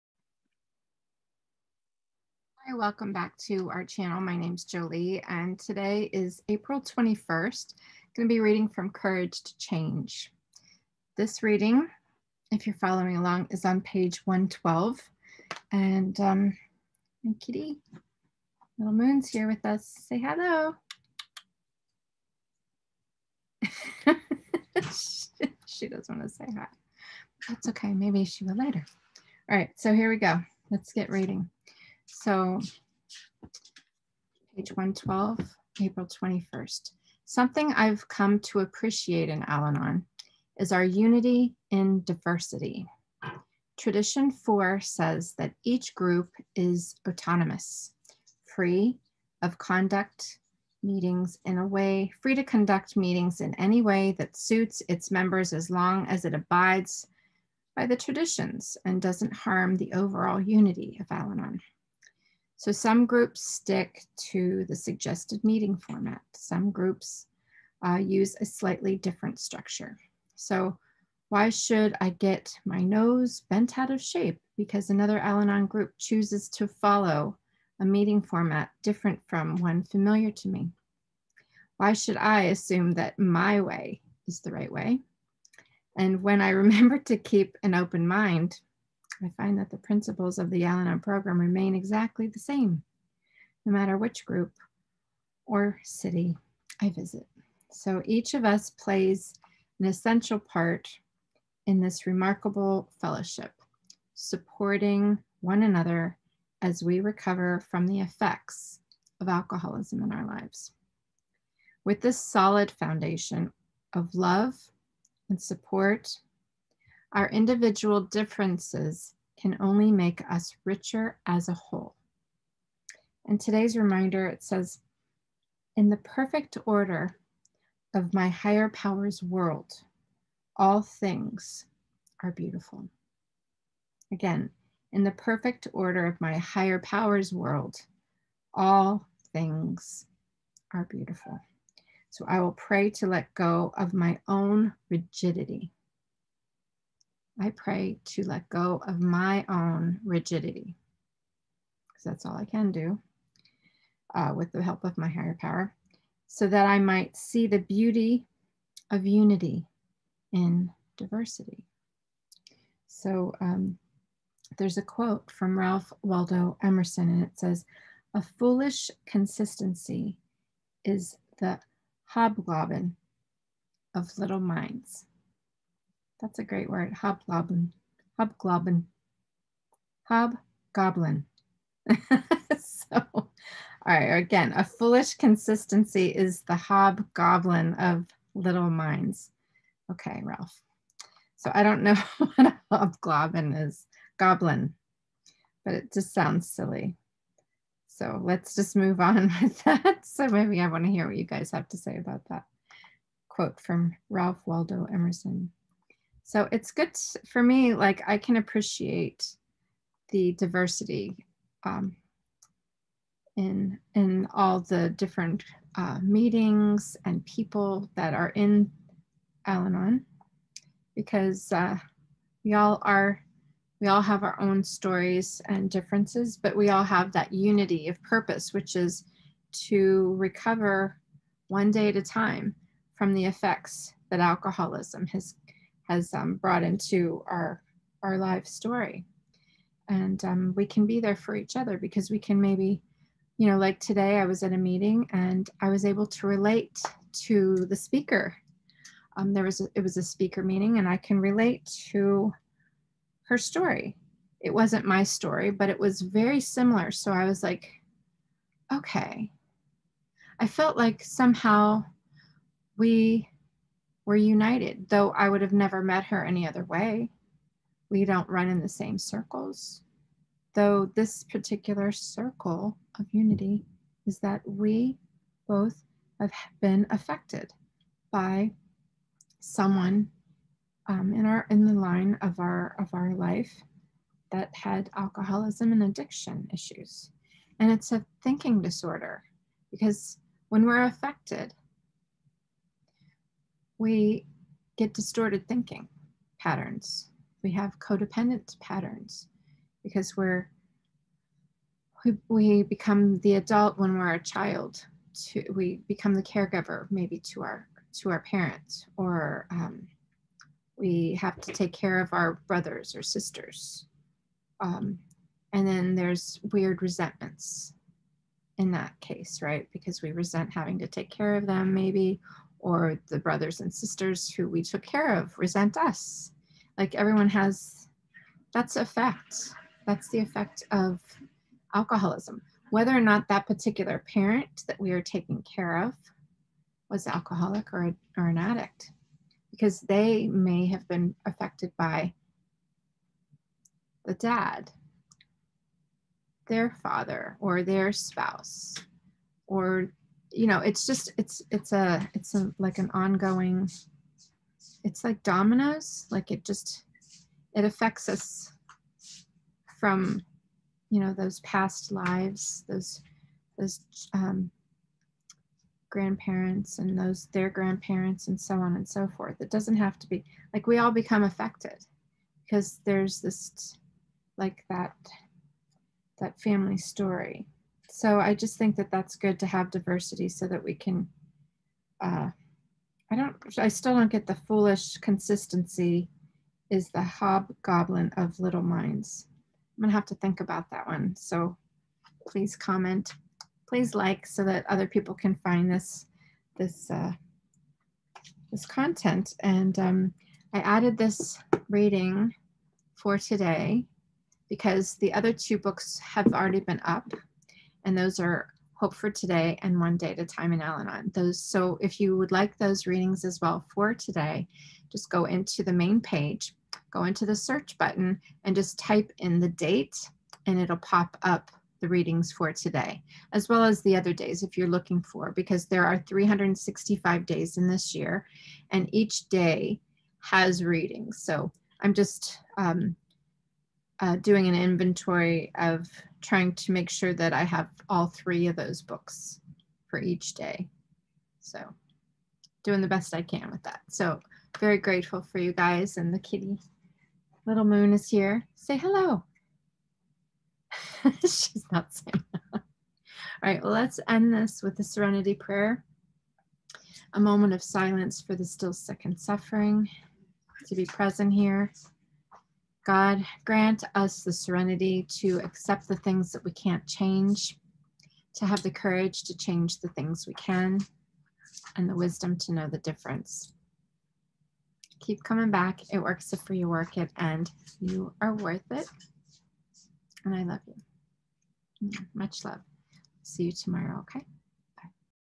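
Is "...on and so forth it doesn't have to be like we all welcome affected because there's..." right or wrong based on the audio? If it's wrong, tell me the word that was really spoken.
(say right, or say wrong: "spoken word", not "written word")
wrong: "become", not "welcome".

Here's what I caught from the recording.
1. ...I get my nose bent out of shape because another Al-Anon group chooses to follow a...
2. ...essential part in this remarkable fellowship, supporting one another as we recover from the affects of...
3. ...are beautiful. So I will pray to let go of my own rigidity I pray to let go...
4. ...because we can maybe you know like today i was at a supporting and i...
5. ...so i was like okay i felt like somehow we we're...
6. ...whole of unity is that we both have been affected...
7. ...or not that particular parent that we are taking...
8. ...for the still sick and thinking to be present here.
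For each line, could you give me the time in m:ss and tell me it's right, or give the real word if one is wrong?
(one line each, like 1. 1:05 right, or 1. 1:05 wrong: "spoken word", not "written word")
1. 1:11 right
2. 1:39 wrong: "effects", not "affects"
3. 2:20 right
4. 4:01 wrong: "meeting", not "supporting"
5. 4:16 right
6. 4:31 wrong: "circle", not "whole"
7. 5:32 right
8. 7:38 wrong: "suffering", not "thinking".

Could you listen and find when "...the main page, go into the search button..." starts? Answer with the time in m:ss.
6:55.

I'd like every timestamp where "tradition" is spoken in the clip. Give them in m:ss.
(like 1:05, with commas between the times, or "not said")
0:43, 0:57.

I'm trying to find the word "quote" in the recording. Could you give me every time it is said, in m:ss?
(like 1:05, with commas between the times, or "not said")
2:44, 3:23.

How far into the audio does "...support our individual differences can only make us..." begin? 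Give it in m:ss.
1:55.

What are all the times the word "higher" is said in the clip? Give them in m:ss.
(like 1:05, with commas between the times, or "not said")
2:08, 2:16, 2:35.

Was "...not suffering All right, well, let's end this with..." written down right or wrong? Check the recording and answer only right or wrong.
wrong.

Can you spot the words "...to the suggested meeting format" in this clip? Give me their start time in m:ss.
1:04.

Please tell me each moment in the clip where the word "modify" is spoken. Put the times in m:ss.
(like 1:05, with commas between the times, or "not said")
not said.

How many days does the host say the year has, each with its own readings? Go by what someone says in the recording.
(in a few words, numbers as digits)
365.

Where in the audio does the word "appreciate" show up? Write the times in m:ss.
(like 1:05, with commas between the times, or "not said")
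0:38, 3:28.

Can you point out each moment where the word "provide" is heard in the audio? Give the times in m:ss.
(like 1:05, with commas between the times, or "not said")
not said.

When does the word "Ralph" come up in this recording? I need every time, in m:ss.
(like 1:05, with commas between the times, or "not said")
2:45, 3:10, 3:24.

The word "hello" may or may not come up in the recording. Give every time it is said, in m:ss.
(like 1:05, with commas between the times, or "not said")
0:20, 7:28.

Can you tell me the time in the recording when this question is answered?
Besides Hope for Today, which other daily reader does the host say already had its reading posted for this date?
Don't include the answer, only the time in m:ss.
6:49.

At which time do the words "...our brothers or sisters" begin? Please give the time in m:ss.
5:12.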